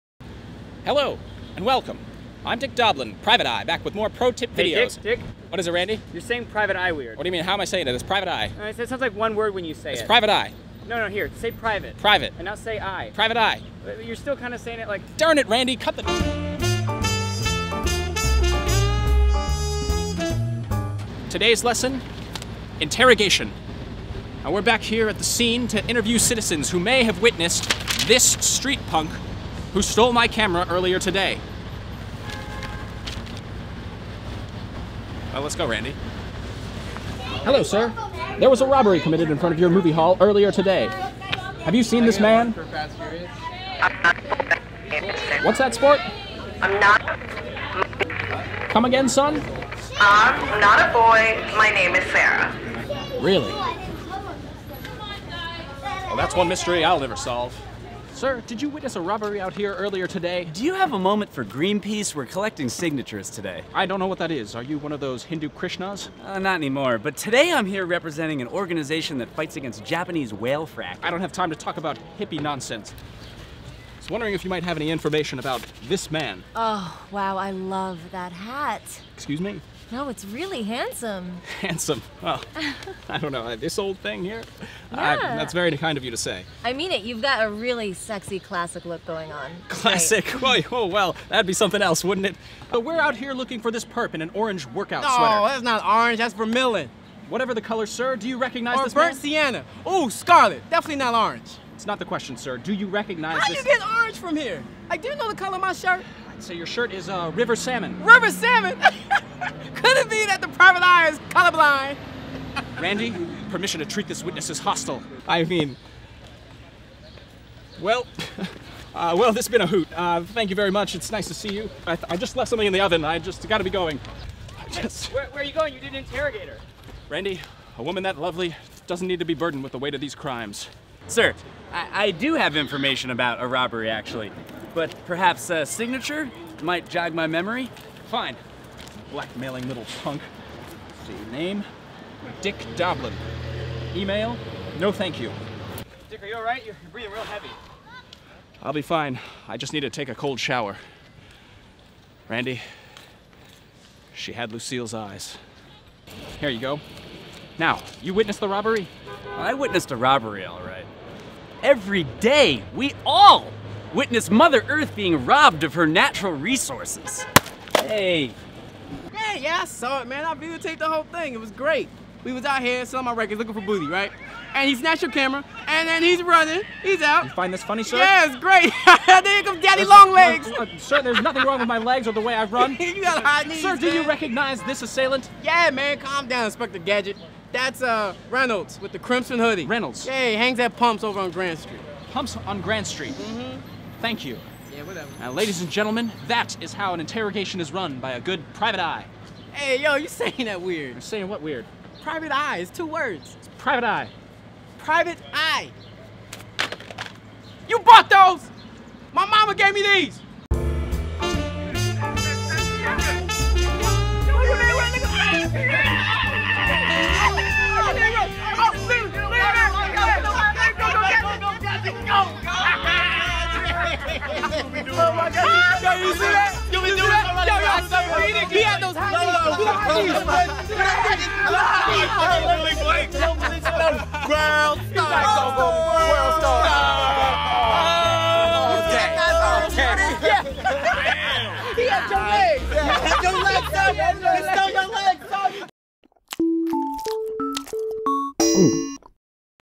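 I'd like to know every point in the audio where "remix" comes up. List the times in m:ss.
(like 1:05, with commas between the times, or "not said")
not said.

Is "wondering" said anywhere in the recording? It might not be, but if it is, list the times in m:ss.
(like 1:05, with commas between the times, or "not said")
1:14.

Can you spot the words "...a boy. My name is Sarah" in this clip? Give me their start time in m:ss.
0:50.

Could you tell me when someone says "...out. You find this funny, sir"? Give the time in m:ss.
2:57.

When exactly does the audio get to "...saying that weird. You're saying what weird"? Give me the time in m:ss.
3:20.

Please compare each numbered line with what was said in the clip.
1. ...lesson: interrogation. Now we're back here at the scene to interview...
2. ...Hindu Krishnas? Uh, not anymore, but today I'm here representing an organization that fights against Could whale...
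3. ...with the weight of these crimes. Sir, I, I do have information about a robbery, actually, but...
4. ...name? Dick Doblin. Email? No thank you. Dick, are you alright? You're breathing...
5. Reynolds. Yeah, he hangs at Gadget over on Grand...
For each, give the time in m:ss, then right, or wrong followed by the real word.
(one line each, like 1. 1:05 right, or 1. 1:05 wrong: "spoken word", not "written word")
1. 0:21 right
2. 1:05 wrong: "Japanese", not "Could"
3. 2:09 right
4. 2:21 right
5. 3:09 wrong: "Pumps", not "Gadget".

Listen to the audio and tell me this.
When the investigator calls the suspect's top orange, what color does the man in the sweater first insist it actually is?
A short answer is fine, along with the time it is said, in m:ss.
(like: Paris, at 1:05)
Vermilion, at 1:36.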